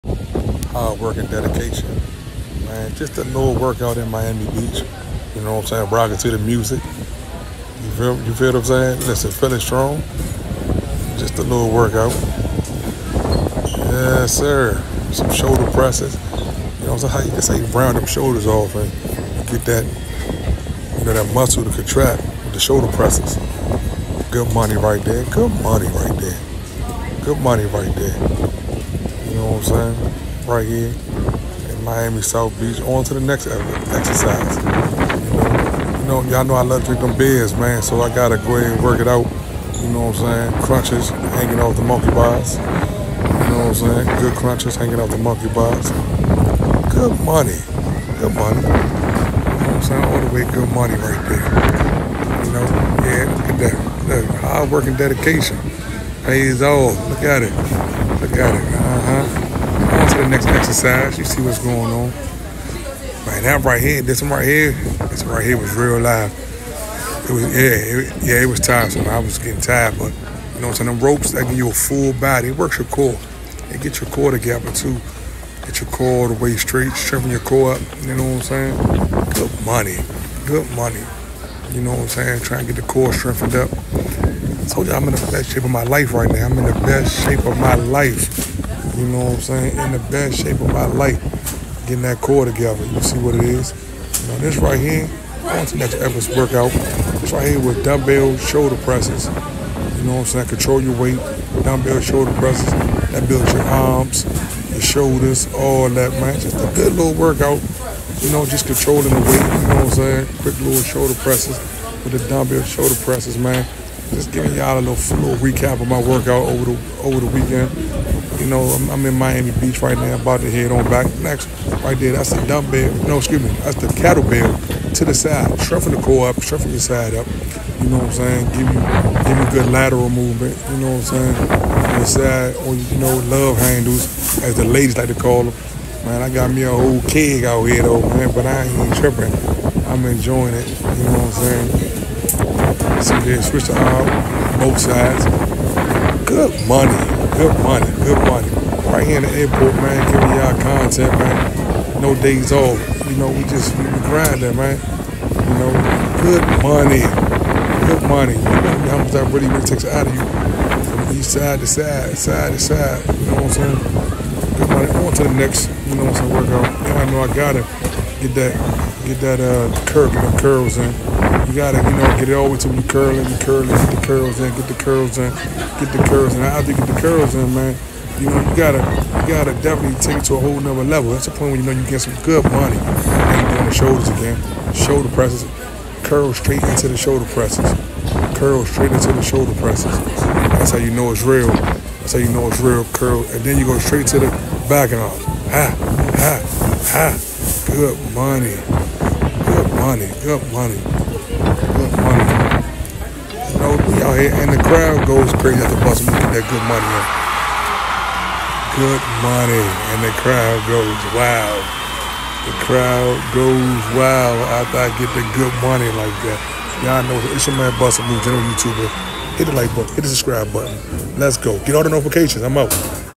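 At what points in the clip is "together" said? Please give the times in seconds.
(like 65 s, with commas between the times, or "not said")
74 s, 92 s.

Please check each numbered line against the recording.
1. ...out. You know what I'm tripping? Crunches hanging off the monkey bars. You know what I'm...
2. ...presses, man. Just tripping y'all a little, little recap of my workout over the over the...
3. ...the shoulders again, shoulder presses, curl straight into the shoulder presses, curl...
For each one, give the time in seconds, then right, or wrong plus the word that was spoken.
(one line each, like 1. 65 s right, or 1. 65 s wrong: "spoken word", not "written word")
1. 39 s wrong: "saying", not "tripping"
2. 113 s wrong: "giving", not "tripping"
3. 183 s right.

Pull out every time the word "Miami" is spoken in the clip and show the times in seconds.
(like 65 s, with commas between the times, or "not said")
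4 s, 31 s, 119 s.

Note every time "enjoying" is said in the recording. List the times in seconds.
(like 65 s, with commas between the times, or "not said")
140 s.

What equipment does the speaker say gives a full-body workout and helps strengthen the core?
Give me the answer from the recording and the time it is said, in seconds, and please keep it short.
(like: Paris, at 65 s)
The ropes, at 70 s.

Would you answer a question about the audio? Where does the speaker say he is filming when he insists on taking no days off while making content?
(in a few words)
The airport.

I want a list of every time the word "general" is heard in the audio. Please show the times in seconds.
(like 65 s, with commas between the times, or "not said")
218 s.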